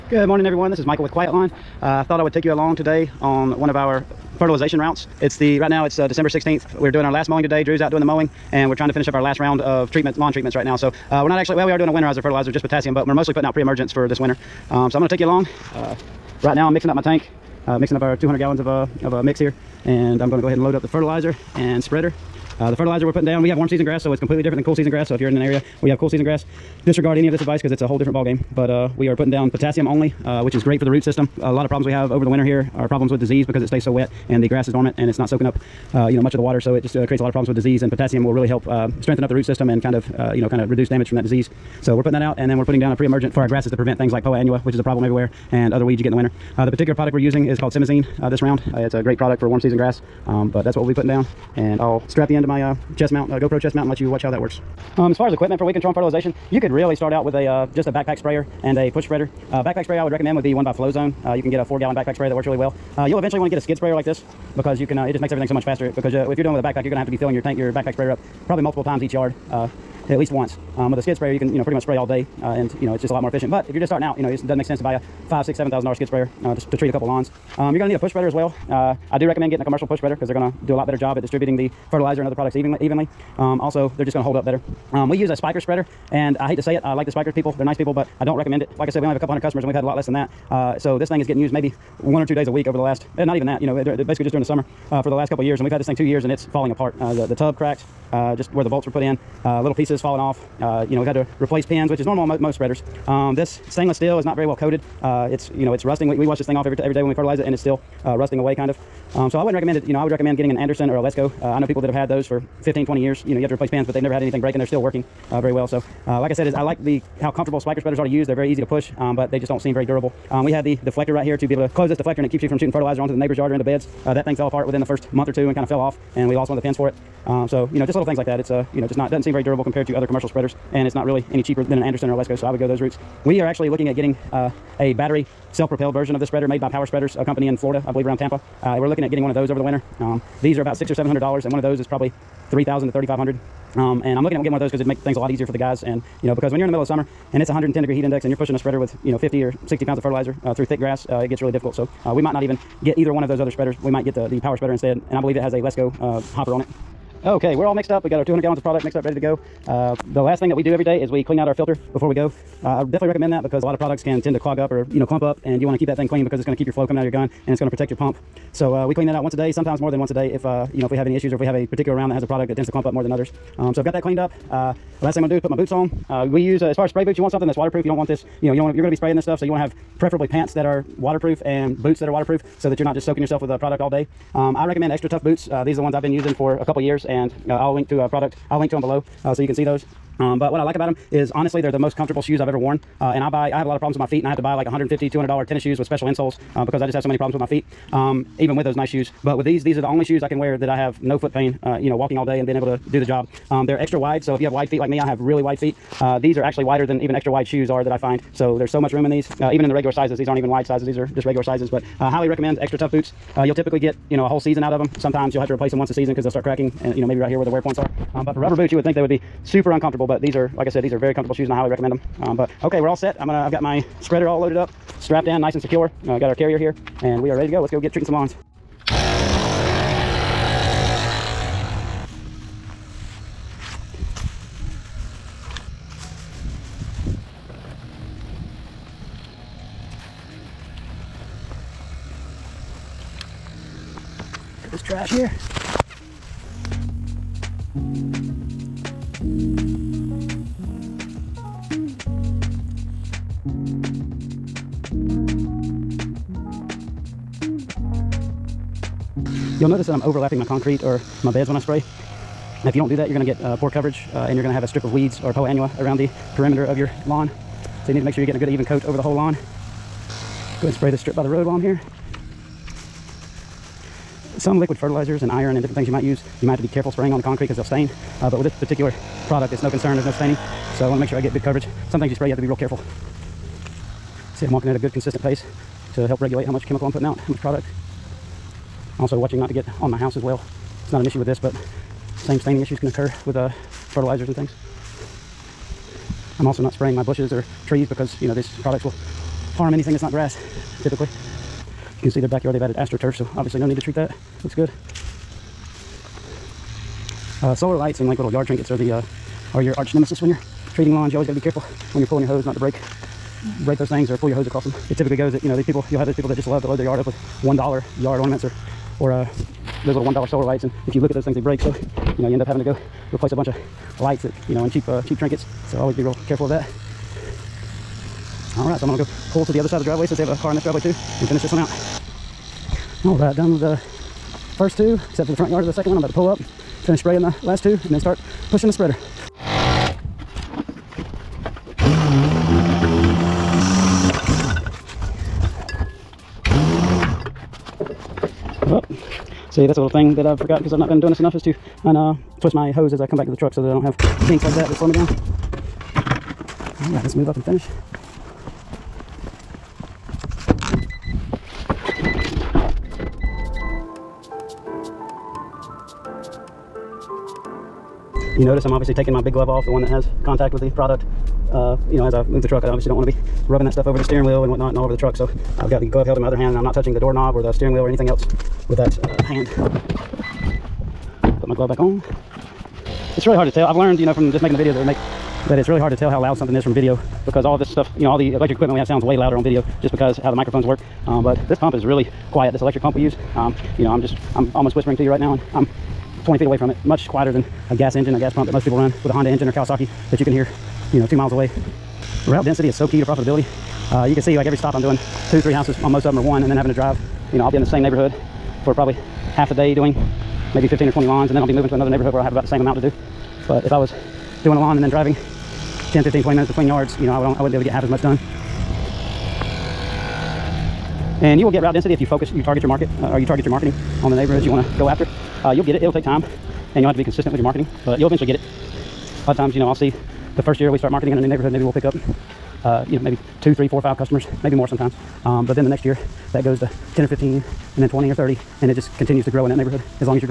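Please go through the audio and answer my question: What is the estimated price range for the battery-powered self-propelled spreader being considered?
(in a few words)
3,000 to 3,500.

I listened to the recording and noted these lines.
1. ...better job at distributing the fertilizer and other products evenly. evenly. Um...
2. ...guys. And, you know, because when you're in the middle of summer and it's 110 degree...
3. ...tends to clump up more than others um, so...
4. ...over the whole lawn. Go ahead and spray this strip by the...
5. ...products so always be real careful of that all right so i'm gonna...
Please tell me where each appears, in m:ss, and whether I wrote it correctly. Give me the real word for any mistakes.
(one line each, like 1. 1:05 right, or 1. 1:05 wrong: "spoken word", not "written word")
1. 1:20 right
2. 2:25 right
3. 2:52 right
4. 4:28 right
5. 5:25 wrong: "trinkets", not "products".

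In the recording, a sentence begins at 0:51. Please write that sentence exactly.
And I'll strap the end of my uh, chest mount, uh, GoPro chest mount, and let you watch how that works.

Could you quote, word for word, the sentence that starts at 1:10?
Um, with a skid sprayer, you can, you know, pretty much spray all day.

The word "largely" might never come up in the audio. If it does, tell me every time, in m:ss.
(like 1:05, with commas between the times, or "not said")
not said.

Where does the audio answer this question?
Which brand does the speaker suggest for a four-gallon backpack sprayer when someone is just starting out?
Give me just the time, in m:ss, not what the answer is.
1:00.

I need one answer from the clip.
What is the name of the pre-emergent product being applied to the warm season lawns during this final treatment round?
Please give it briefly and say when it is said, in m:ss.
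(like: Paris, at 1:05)
Simazine, at 0:47.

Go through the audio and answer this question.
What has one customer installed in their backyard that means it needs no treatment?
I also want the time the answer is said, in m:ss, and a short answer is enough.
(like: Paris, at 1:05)
AstroTurf, at 5:02.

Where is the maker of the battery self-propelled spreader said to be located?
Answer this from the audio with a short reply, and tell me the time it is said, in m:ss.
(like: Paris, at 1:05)
Tampa, at 2:18.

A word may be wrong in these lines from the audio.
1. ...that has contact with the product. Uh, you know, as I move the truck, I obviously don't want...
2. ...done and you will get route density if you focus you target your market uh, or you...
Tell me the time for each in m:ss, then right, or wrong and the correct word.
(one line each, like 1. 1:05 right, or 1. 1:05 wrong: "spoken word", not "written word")
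1. 6:09 right
2. 6:58 right.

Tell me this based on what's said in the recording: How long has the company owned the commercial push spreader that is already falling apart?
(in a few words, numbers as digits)
2 years.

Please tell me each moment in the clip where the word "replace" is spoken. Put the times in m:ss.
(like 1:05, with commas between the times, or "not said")
1:41, 1:53, 3:35, 5:23.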